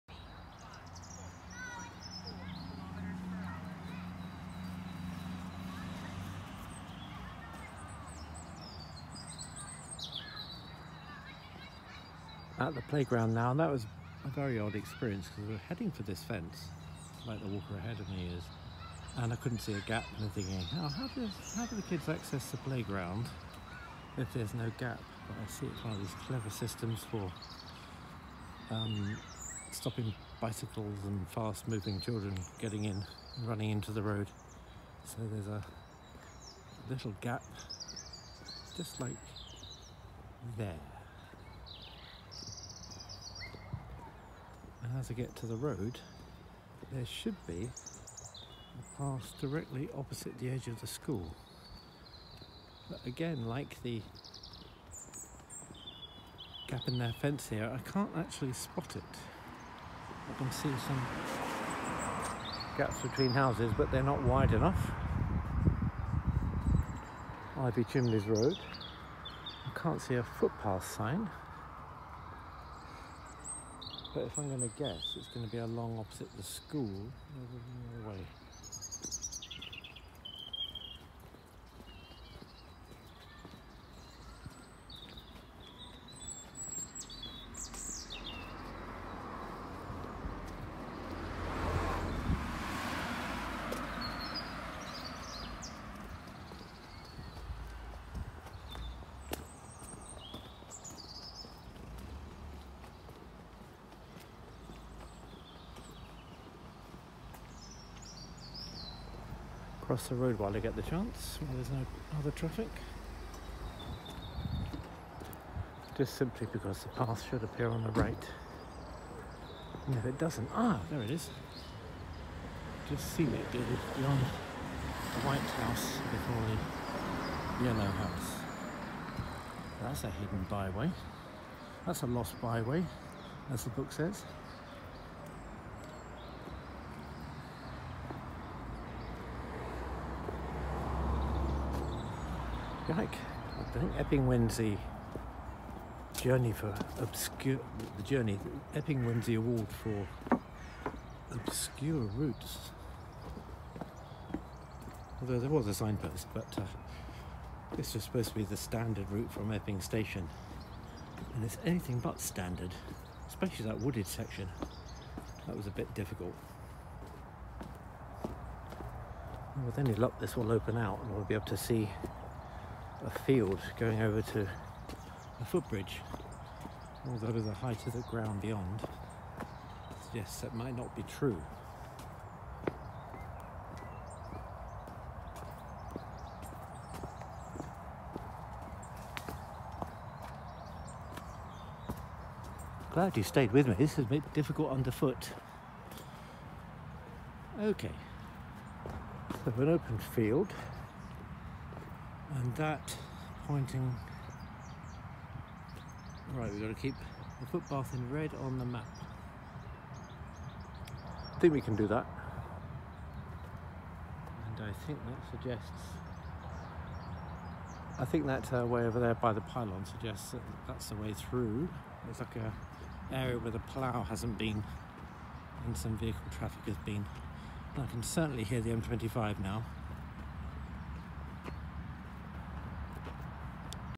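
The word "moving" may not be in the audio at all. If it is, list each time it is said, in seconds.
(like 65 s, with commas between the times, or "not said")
31 s.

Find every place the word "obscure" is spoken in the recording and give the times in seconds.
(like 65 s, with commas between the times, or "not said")
146 s, 151 s.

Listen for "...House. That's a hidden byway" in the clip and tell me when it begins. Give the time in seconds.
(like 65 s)
127 s.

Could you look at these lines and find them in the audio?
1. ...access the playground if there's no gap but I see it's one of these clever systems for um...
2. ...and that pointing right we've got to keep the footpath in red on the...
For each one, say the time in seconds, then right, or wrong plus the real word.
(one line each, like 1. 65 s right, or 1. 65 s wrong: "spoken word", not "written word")
1. 22 s right
2. 202 s right.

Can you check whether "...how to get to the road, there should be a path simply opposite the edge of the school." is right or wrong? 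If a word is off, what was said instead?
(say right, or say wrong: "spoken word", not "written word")
wrong: "directly", not "simply".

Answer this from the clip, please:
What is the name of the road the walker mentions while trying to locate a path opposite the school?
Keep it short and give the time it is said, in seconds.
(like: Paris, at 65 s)
Ivy Chimneys Road, at 67 s.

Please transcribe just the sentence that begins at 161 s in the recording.
And it's anything but standard, especially that wooded section.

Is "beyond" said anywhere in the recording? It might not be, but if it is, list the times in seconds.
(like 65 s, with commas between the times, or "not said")
123 s, 178 s.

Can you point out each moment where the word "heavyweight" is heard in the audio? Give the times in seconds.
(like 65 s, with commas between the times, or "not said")
not said.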